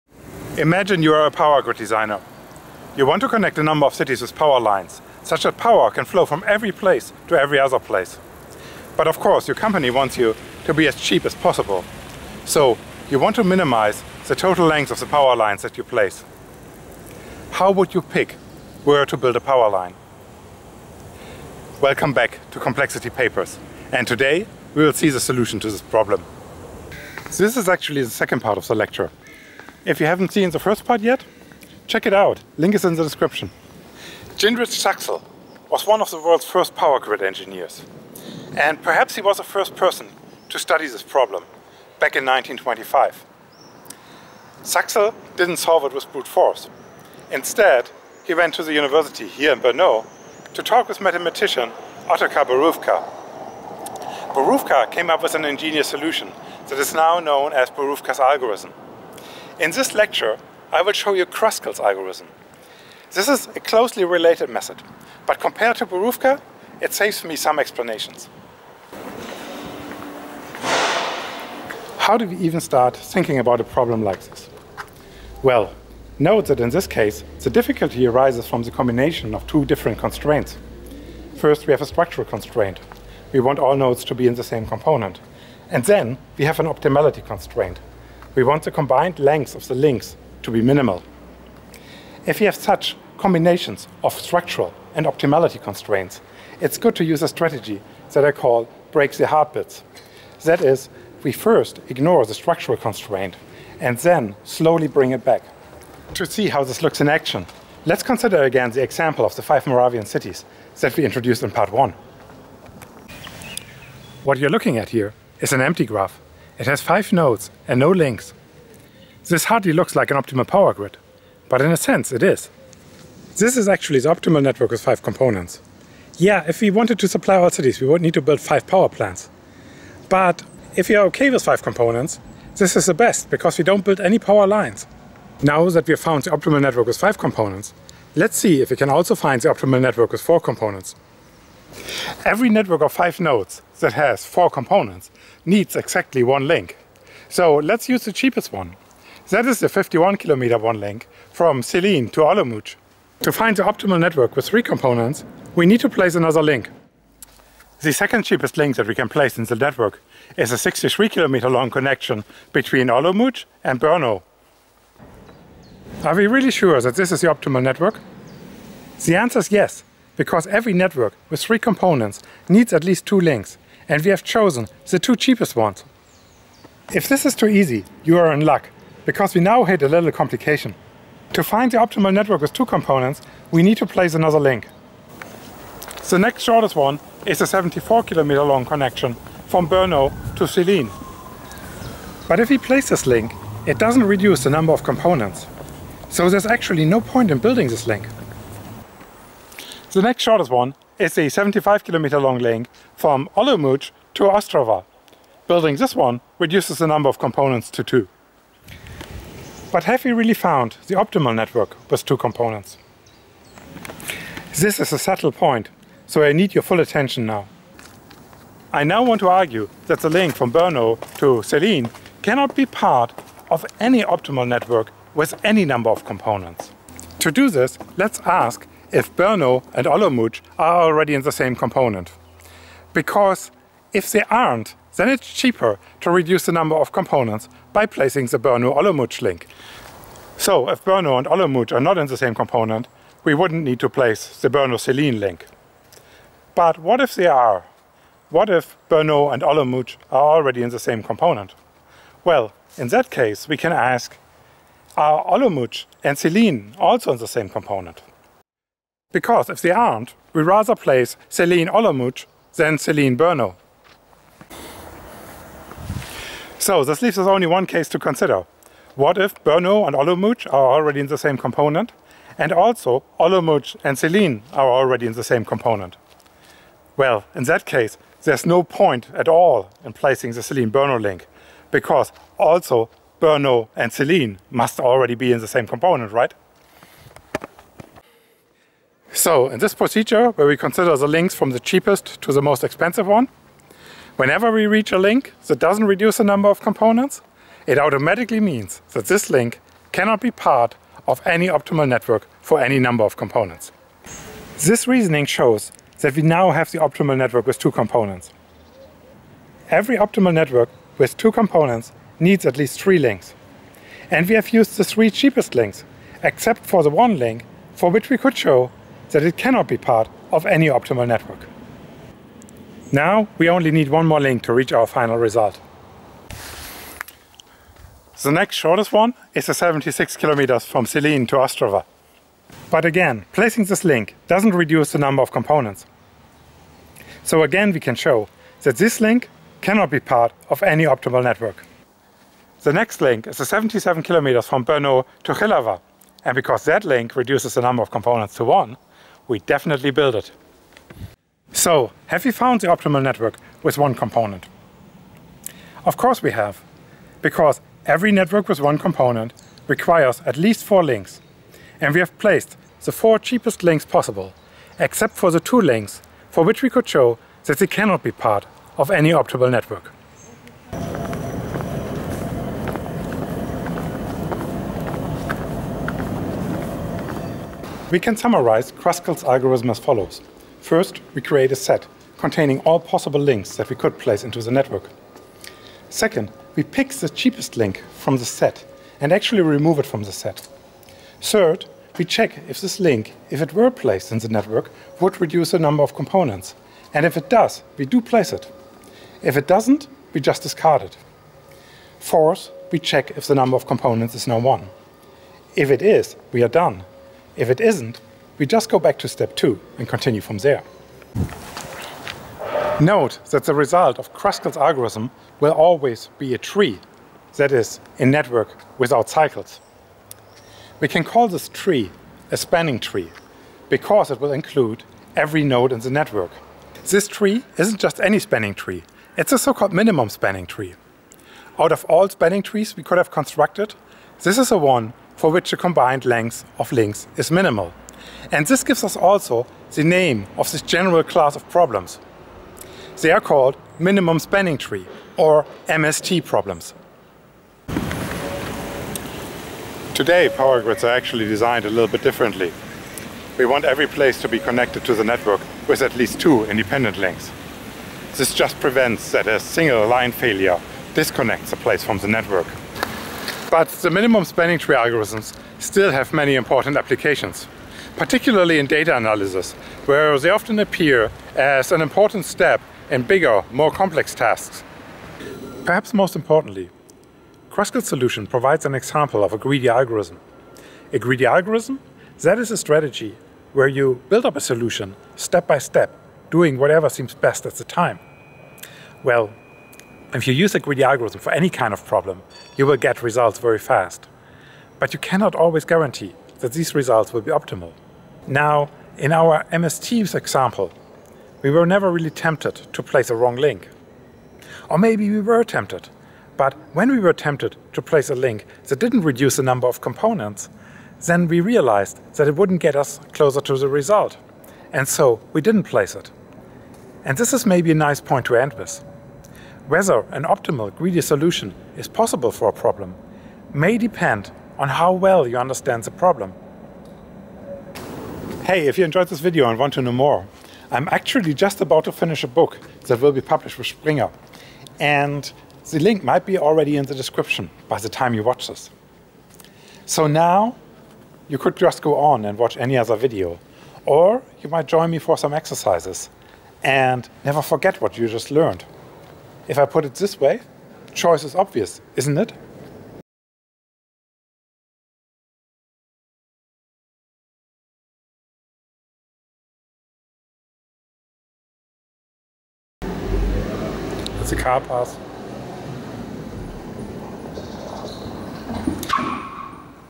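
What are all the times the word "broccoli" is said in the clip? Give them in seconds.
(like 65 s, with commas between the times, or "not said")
not said.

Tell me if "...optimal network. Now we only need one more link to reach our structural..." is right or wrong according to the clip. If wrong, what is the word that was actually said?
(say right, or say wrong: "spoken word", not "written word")
wrong: "final", not "structural".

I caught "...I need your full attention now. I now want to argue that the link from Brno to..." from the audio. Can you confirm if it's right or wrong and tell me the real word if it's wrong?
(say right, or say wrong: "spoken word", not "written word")
right.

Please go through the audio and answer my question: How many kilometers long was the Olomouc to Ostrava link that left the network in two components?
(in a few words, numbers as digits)
75.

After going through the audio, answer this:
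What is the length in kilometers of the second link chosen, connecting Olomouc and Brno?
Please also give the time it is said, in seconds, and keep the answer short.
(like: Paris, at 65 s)
63, at 160 s.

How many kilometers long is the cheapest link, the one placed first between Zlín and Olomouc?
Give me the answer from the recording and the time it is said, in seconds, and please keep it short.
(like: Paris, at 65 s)
51, at 149 s.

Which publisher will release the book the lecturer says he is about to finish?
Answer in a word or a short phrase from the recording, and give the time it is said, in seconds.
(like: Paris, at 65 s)
Springer, at 533 s.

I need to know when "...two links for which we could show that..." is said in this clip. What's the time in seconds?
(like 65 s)
365 s.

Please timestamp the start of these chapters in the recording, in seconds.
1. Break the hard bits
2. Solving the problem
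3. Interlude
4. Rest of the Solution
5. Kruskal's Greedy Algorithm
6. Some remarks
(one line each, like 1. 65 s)
1. 68 s
2. 105 s
3. 212 s
4. 287 s
5. 370 s
6. 410 s.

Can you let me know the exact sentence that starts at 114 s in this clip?
What you're looking at here is an empty graph it has five nodes and no links.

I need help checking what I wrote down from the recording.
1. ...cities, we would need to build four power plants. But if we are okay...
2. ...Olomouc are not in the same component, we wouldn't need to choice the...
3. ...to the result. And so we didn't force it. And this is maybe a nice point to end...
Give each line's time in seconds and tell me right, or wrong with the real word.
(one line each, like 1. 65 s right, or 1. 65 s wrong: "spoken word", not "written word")
1. 127 s wrong: "five", not "four"
2. 241 s wrong: "place", not "choice"
3. 513 s wrong: "place", not "force".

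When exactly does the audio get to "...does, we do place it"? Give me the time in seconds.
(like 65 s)
397 s.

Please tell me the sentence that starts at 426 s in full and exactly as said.
This tree isn't just any spanning tree, it's a so-called minimum spanning tree.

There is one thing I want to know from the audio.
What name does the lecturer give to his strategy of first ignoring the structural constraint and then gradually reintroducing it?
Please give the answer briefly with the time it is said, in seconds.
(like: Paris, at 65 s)
break the hard bits, at 98 s.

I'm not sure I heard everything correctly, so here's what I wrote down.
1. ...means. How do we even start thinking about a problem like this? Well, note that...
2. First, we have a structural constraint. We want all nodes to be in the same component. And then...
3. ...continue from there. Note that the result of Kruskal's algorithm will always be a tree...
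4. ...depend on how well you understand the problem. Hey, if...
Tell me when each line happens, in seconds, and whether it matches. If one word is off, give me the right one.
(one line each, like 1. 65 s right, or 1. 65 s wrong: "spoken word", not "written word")
1. 67 s wrong: "explanations", not "means"
2. 81 s right
3. 409 s right
4. 523 s right.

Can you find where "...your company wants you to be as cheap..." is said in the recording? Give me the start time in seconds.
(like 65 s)
9 s.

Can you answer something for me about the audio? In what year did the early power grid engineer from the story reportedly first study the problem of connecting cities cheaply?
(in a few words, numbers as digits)
1925.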